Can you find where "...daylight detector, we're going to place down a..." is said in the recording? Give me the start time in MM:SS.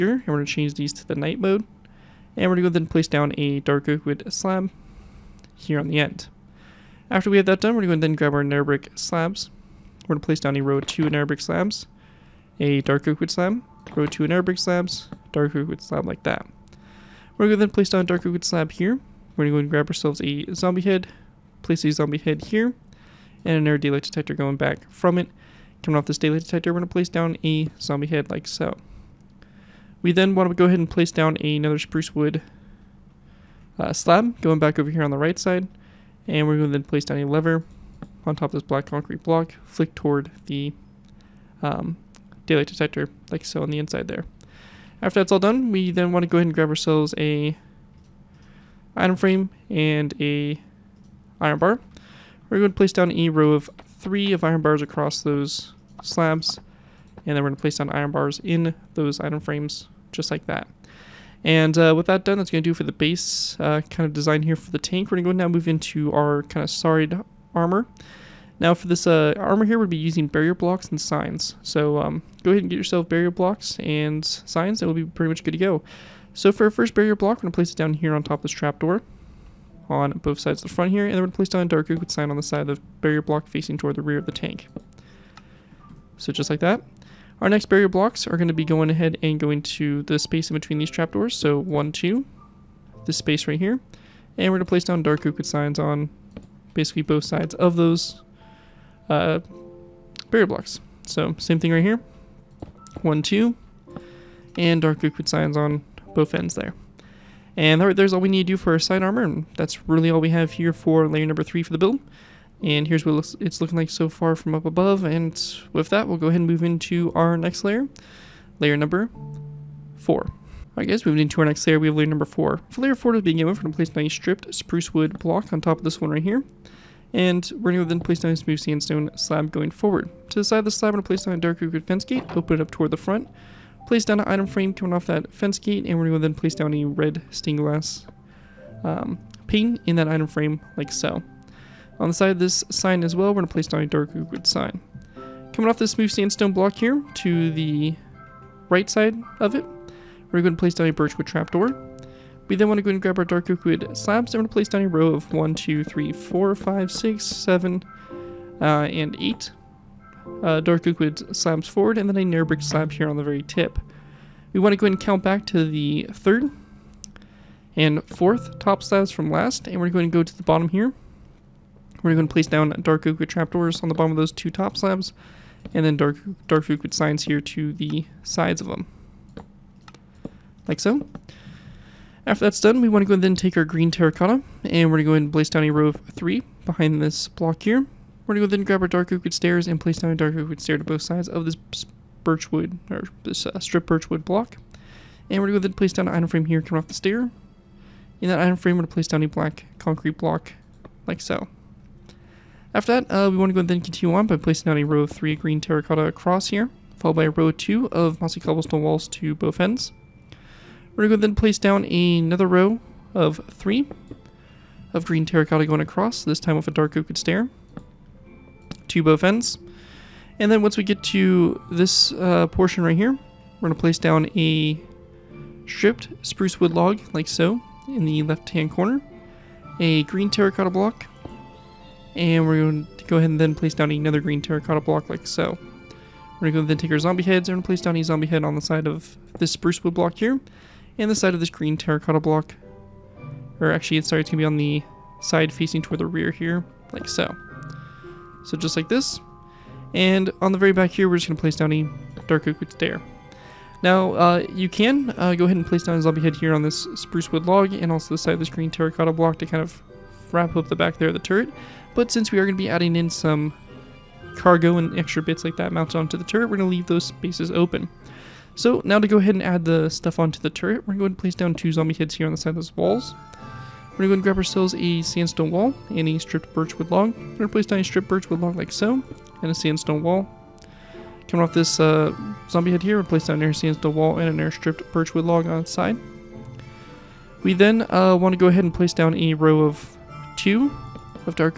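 00:26.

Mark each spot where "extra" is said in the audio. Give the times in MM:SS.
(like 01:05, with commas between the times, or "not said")
04:24.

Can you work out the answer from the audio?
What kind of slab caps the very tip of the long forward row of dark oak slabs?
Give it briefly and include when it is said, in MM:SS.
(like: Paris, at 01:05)
Brick slab, at 02:42.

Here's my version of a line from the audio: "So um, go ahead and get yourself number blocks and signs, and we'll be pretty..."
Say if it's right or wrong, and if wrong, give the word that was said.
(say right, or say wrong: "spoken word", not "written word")
wrong: "barrier", not "number".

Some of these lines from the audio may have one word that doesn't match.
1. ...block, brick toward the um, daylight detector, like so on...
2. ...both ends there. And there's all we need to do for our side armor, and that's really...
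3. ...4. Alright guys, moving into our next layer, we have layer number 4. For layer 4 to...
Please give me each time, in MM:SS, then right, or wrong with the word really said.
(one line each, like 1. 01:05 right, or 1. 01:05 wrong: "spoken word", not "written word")
1. 00:39 wrong: "flick", not "brick"
2. 01:46 right
3. 01:59 right.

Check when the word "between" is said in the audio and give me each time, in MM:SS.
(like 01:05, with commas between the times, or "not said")
01:30.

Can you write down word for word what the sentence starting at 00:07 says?
After we have that done, we're going to then grab our nether brick slabs.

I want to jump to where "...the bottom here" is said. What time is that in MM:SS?
02:50.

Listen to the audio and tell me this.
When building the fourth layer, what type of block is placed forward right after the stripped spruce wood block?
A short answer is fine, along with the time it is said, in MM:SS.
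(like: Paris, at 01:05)
Smooth sandstone slab, at 02:08.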